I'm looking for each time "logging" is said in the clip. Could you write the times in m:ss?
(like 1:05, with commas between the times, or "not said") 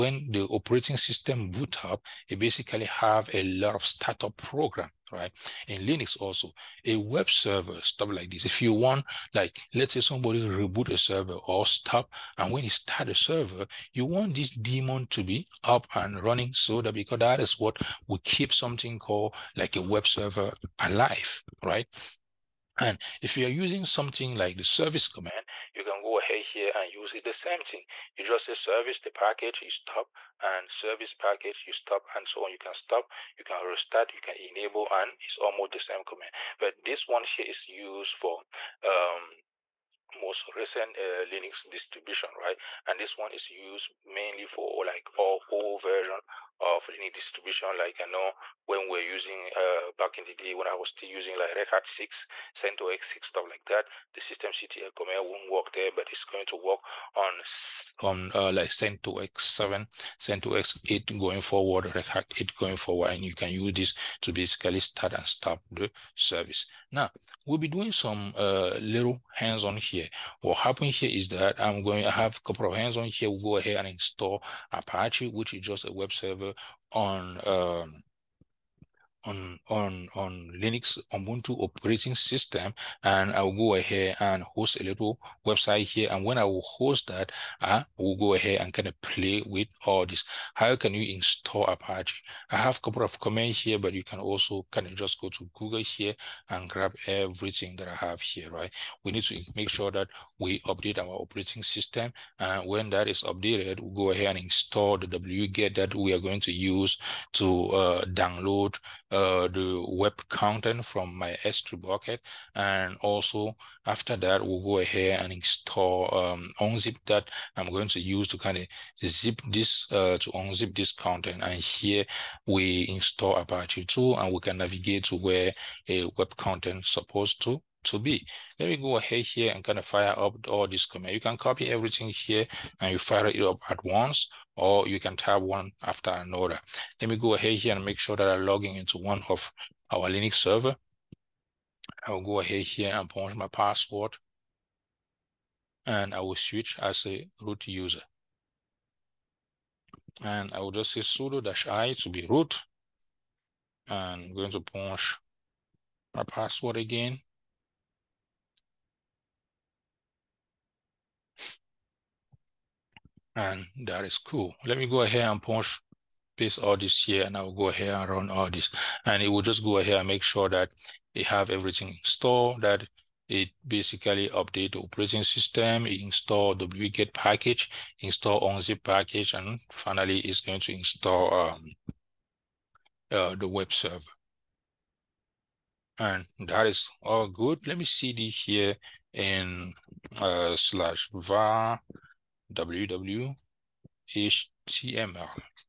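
2:18.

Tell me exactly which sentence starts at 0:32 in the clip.
You can stop, you can restart, you can enable, and it's almost the same command.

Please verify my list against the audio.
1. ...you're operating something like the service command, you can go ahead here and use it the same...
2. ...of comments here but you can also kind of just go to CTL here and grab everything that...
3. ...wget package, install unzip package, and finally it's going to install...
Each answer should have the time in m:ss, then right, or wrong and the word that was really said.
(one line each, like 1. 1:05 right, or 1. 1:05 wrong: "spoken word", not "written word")
1. 0:23 wrong: "using", not "operating"
2. 1:33 wrong: "Google", not "CTL"
3. 2:56 right.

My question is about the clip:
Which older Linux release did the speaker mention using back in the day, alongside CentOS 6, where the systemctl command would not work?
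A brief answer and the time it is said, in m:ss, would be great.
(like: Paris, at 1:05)
Red Hat 6, at 0:51.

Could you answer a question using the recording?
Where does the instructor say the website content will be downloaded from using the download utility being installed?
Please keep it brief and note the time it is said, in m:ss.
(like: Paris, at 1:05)
S3 bucket, at 1:51.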